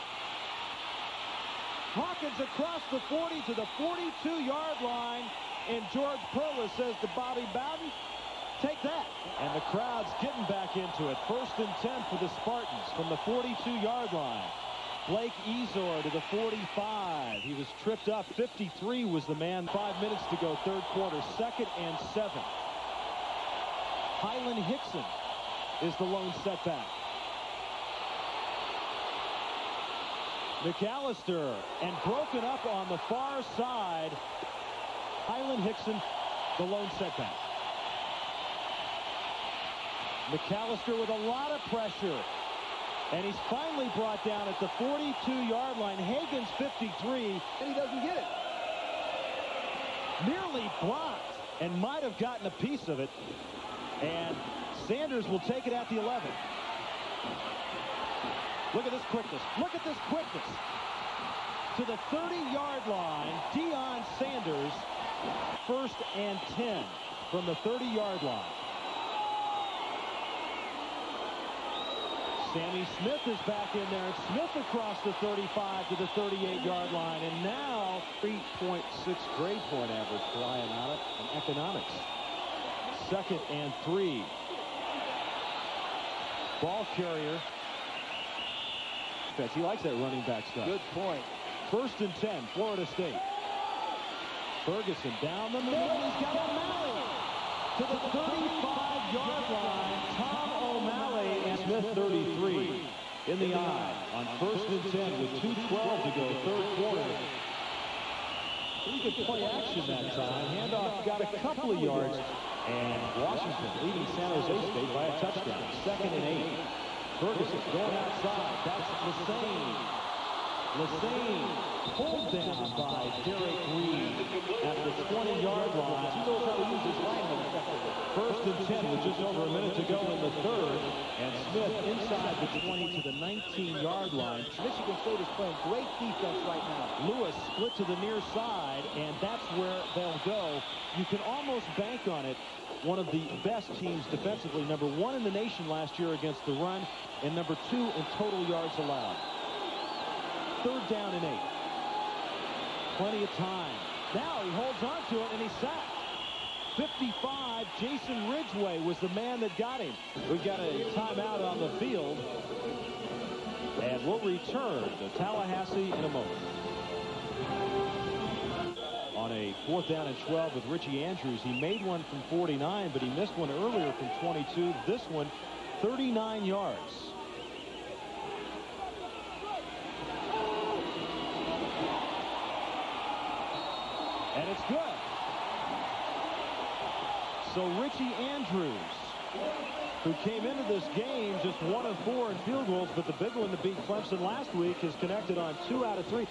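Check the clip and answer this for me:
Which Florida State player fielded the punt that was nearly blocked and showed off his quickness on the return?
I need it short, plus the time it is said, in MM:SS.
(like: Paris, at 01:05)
Deion Sanders, at 01:03.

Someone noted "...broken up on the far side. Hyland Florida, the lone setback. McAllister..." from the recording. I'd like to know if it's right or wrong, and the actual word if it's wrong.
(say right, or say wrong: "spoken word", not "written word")
wrong: "Hickson", not "Florida".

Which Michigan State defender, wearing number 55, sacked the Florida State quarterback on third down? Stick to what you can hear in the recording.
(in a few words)
Jason Ridgeway.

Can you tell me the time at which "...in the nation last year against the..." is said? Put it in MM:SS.
02:25.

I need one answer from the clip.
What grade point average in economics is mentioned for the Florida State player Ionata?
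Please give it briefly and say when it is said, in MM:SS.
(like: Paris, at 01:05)
3.6, at 01:18.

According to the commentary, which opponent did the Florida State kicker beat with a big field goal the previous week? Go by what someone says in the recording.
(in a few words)
Clemson.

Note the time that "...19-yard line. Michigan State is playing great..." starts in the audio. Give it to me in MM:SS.
02:13.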